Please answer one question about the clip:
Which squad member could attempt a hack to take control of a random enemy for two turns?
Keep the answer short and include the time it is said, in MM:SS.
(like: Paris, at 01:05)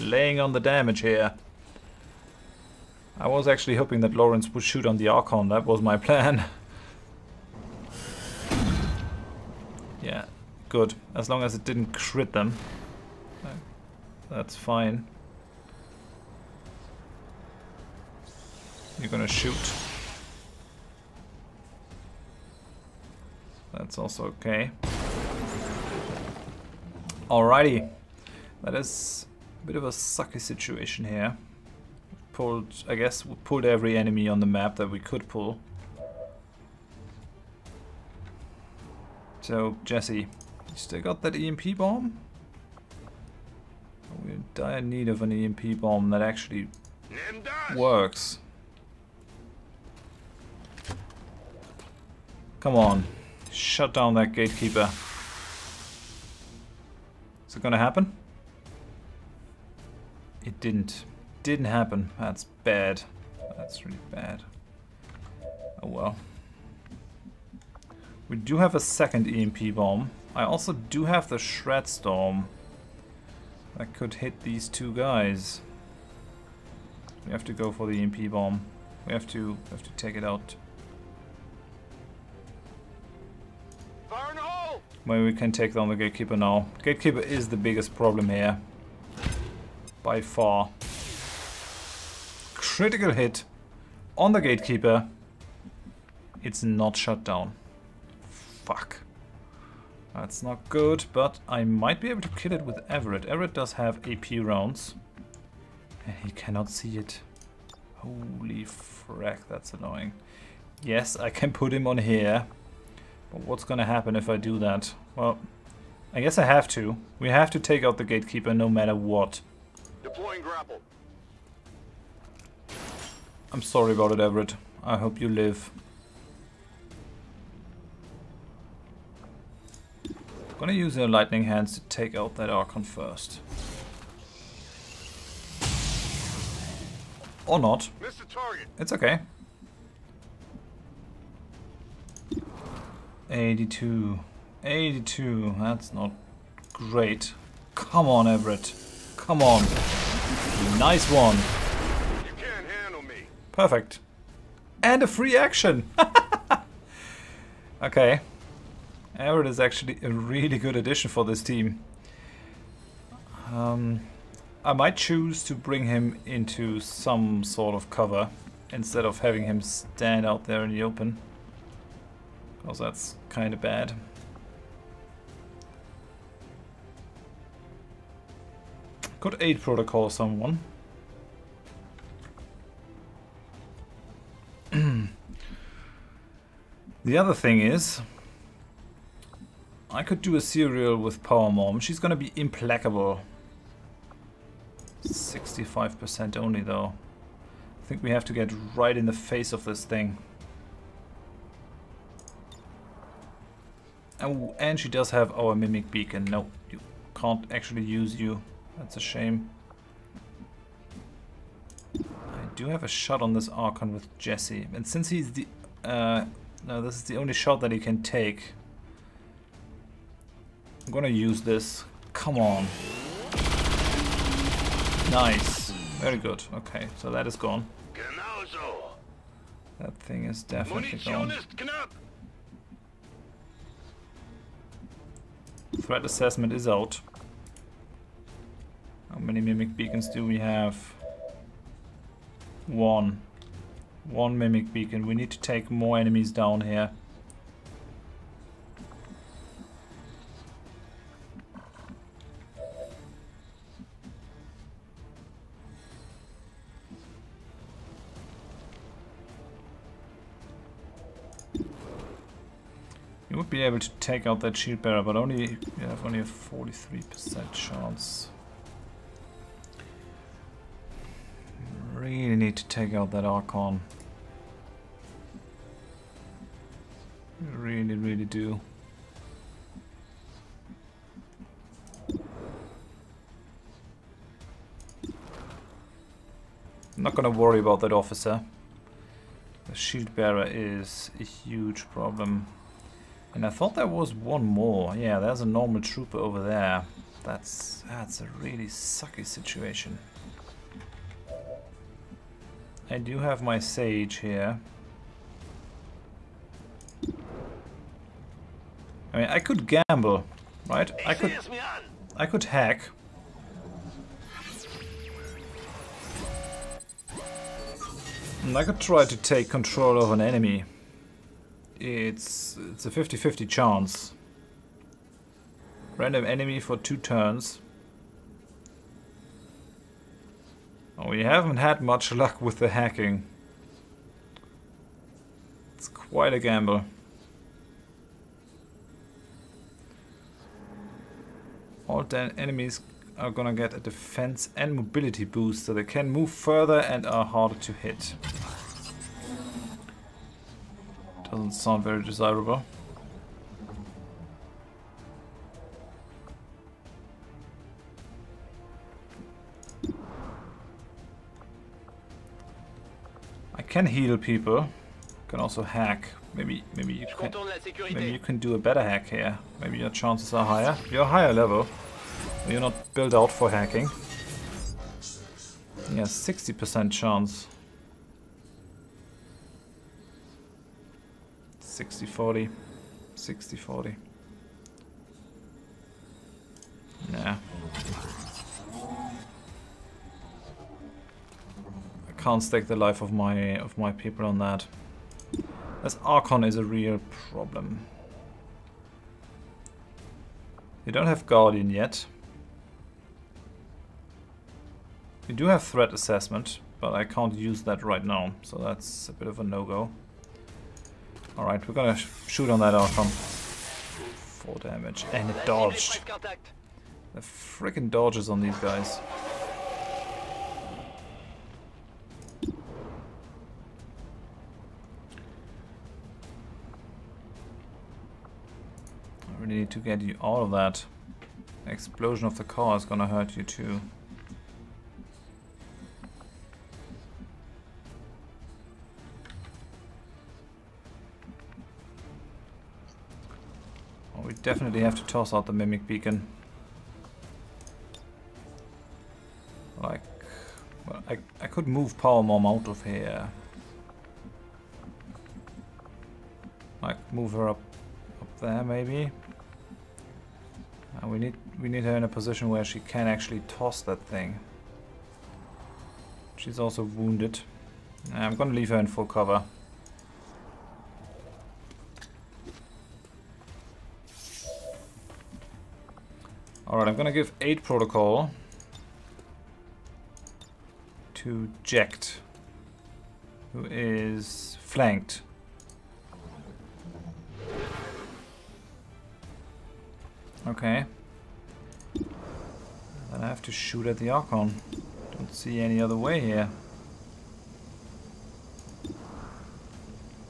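Sage, at 05:03.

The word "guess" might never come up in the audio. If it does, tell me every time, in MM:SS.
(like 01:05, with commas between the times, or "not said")
00:32, 01:56.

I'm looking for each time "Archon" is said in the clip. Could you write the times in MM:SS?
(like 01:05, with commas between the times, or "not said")
00:05, 02:12, 03:33, 04:33, 06:36, 06:52, 08:14.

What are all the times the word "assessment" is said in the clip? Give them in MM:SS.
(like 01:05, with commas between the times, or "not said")
03:56, 06:45.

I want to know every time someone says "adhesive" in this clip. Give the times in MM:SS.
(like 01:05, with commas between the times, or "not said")
not said.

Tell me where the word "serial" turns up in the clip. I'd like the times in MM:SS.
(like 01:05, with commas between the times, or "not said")
03:10.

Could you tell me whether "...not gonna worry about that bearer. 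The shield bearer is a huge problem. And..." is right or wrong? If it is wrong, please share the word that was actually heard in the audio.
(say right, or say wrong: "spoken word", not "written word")
wrong: "officer", not "bearer".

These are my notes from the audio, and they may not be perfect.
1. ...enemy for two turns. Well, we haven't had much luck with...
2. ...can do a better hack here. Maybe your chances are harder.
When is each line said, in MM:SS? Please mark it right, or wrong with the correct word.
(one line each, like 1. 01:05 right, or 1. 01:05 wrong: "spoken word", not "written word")
1. 05:26 right
2. 06:08 wrong: "higher", not "harder".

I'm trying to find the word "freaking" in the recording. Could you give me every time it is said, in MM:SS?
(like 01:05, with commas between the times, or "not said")
06:57.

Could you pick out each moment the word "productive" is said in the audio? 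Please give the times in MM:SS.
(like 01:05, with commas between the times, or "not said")
not said.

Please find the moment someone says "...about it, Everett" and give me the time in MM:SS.
02:03.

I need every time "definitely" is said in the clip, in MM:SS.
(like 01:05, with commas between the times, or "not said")
03:50, 07:24.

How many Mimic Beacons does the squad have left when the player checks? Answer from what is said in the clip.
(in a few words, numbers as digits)
1.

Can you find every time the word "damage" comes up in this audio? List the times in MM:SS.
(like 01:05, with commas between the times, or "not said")
00:00, 06:54.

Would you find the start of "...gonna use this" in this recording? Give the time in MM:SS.
03:40.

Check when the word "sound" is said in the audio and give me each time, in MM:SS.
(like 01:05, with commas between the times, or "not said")
05:51.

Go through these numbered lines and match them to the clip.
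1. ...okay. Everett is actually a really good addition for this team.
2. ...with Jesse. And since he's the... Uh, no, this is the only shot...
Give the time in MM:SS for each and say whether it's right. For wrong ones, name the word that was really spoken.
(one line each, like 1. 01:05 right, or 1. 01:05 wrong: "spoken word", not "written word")
1. 02:37 right
2. 03:33 right.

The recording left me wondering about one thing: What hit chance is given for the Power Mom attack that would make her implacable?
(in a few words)
65%.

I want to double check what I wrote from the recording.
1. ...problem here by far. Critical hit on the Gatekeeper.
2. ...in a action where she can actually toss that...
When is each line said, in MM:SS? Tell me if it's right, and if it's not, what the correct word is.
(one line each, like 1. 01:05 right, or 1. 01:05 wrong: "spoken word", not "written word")
1. 01:27 right
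2. 07:41 wrong: "position", not "action".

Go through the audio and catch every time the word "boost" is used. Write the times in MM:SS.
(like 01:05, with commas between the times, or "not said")
05:45.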